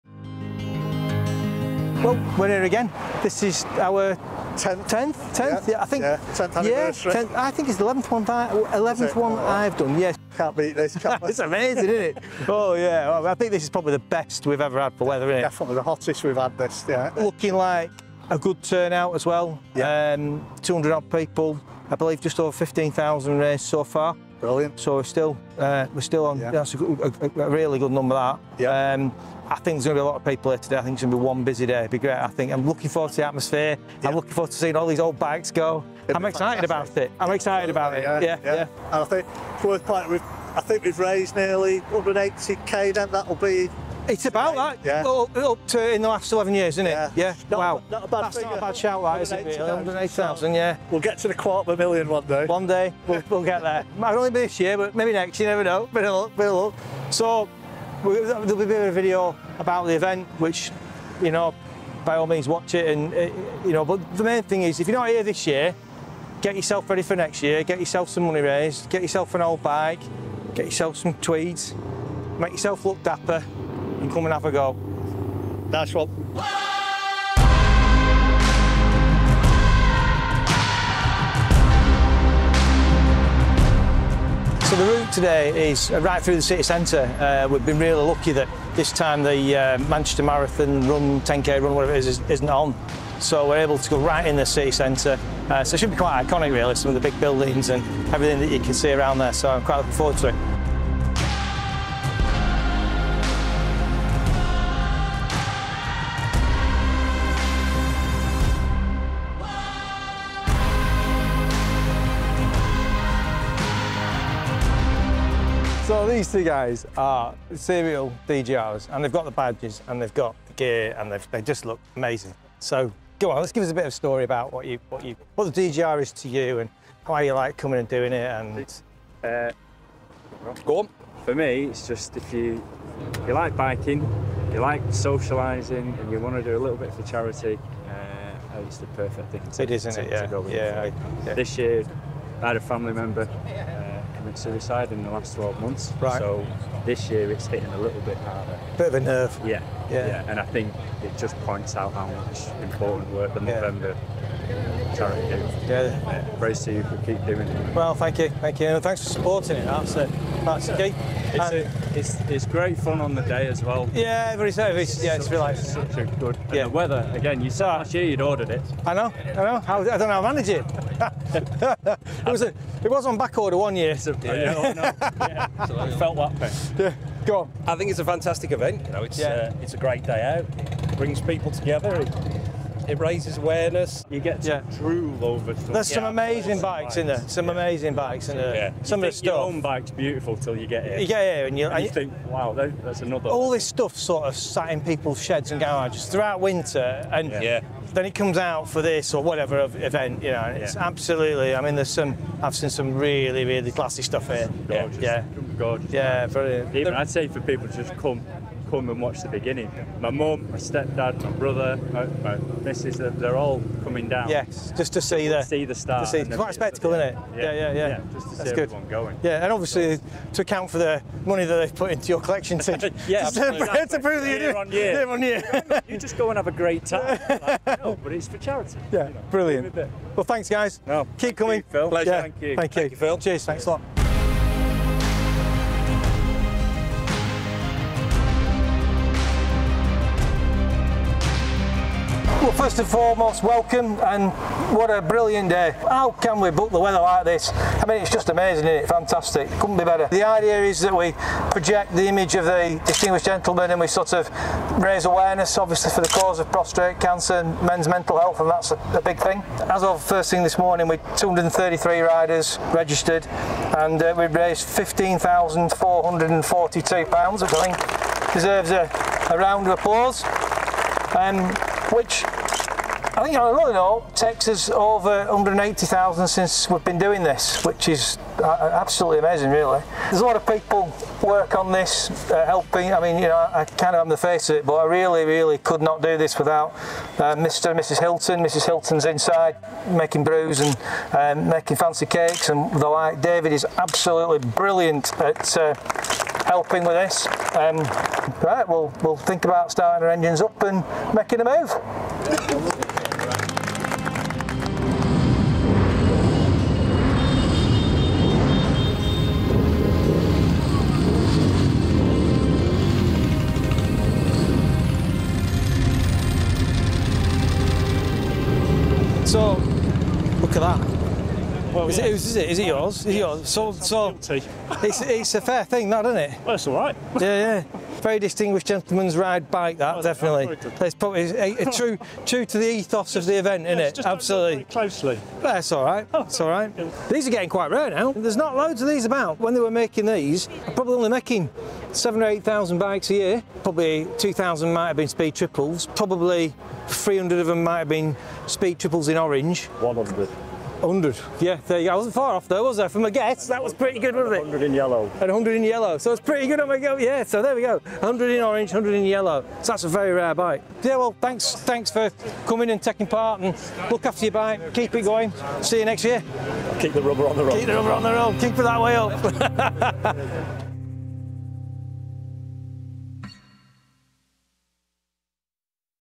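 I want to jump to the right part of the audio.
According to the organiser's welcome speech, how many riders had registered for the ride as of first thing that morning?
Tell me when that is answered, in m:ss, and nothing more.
4:21.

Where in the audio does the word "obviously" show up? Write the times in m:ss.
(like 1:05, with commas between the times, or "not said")
3:39, 4:15.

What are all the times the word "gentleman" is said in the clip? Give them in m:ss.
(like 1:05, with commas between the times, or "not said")
4:13, 5:28.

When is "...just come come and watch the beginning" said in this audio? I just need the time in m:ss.
3:27.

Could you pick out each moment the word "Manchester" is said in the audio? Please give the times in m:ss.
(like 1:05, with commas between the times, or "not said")
1:29.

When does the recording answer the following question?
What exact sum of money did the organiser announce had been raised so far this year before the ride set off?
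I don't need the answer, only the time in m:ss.
4:24.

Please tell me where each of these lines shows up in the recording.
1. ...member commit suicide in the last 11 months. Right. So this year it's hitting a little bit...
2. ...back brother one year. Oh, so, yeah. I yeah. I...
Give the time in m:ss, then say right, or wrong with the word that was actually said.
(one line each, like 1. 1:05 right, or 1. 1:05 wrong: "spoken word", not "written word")
1. 2:22 wrong: "12", not "11"
2. 2:53 wrong: "order", not "brother".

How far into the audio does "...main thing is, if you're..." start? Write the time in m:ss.
1:04.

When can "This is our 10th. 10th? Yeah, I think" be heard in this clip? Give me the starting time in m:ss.
0:03.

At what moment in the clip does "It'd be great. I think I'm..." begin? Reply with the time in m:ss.
0:31.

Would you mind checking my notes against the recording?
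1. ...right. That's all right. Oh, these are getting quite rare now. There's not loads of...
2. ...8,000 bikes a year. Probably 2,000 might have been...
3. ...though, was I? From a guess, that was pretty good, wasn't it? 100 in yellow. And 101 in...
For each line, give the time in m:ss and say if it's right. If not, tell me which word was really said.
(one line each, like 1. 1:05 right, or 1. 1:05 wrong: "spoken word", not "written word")
1. 5:35 right
2. 5:42 right
3. 5:52 wrong: "100", not "101".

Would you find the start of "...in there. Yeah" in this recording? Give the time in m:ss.
3:08.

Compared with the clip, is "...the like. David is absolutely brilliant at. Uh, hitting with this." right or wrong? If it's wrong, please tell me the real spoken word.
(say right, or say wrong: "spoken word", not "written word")
wrong: "helping", not "hitting".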